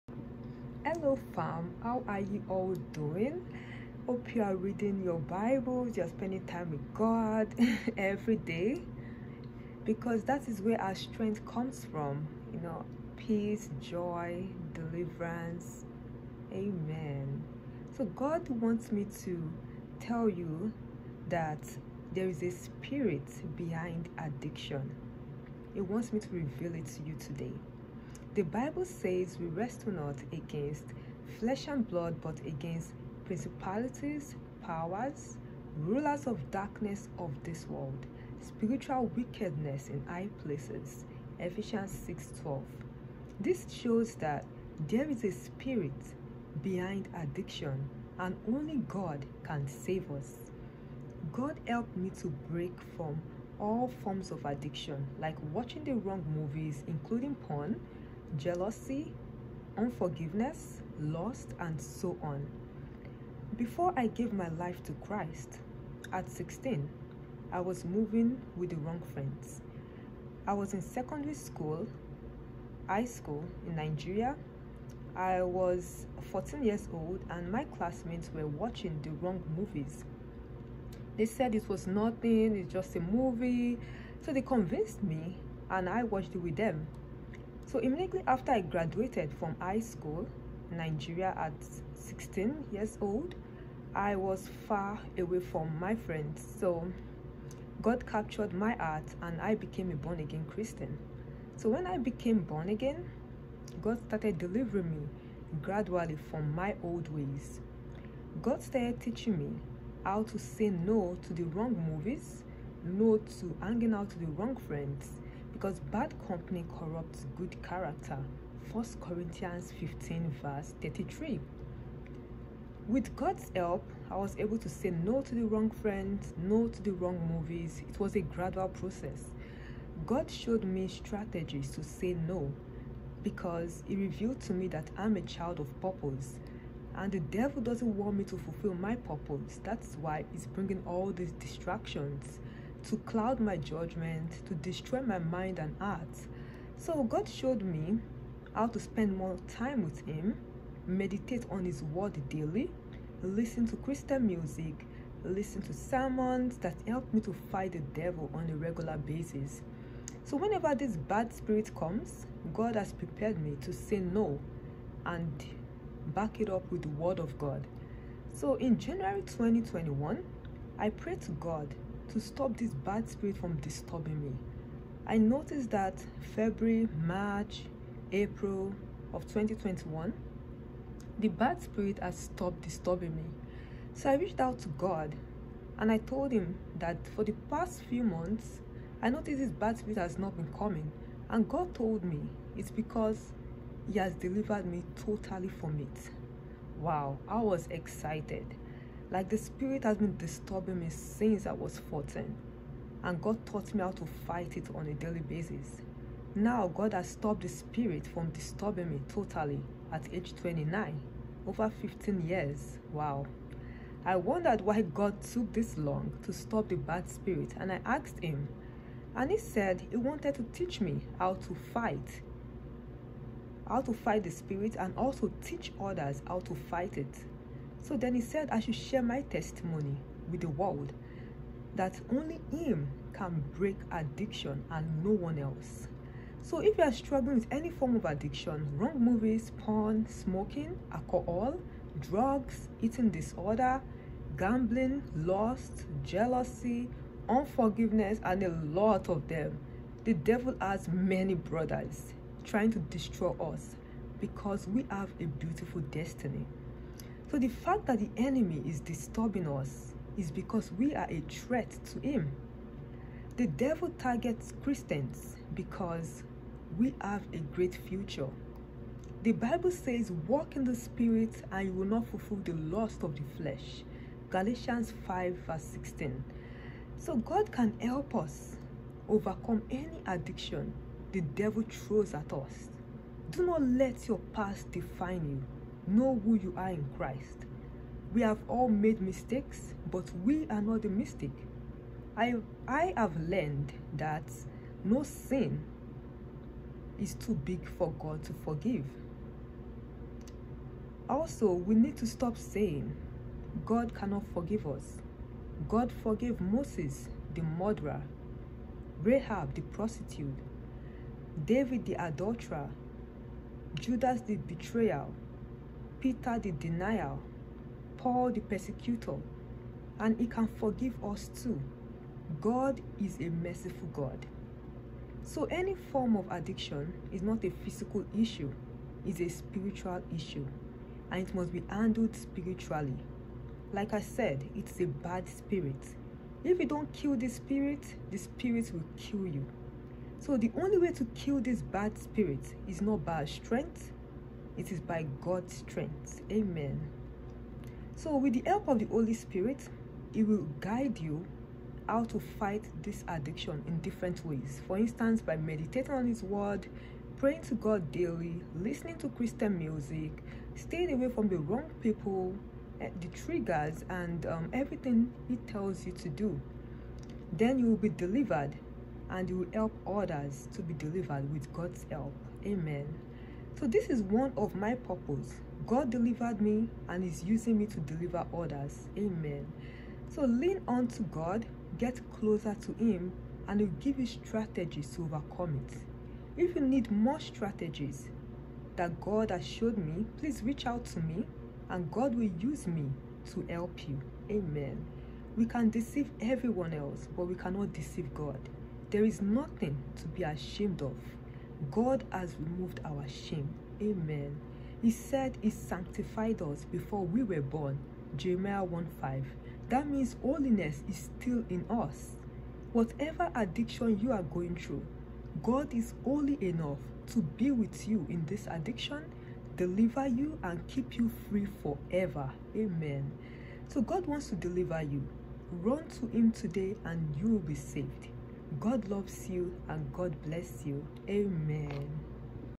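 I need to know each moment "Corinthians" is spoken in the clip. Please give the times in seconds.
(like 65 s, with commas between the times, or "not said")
118 s.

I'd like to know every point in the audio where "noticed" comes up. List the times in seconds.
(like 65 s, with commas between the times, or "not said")
175 s, 189 s.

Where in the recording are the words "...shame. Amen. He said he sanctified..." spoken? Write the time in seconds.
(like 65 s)
403 s.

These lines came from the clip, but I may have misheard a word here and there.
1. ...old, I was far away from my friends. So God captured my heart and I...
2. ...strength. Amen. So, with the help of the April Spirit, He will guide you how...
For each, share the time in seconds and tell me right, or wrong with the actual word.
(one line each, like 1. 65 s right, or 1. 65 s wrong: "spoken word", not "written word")
1. 92 s right
2. 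345 s wrong: "Holy", not "April".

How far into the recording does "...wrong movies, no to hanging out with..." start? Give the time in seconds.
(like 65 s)
111 s.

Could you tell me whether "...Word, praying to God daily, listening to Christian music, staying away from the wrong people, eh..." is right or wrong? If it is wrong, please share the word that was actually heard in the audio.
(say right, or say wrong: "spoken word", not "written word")
right.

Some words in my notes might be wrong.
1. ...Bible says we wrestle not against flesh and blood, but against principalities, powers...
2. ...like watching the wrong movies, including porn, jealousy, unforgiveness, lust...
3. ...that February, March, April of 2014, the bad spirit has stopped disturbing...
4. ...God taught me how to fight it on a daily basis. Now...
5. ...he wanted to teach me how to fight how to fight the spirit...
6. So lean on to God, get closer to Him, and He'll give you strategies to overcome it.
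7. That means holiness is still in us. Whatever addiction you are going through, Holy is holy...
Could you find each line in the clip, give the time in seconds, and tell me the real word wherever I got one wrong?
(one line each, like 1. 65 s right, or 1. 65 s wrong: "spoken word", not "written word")
1. 28 s right
2. 55 s right
3. 175 s wrong: "2021", not "2014"
4. 203 s right
5. 219 s right
6. 380 s right
7. 409 s wrong: "God", not "Holy".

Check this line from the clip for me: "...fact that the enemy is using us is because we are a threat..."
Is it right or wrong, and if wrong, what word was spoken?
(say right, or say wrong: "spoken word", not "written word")
wrong: "disturbing", not "using".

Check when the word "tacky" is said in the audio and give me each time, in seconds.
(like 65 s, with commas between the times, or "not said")
not said.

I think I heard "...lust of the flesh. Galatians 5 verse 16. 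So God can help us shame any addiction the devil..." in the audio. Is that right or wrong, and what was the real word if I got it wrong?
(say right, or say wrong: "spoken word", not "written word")
wrong: "overcome", not "shame".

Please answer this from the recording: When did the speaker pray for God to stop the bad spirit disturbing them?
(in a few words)
January 2021.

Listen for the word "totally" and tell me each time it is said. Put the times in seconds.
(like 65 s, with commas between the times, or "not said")
195 s, 209 s.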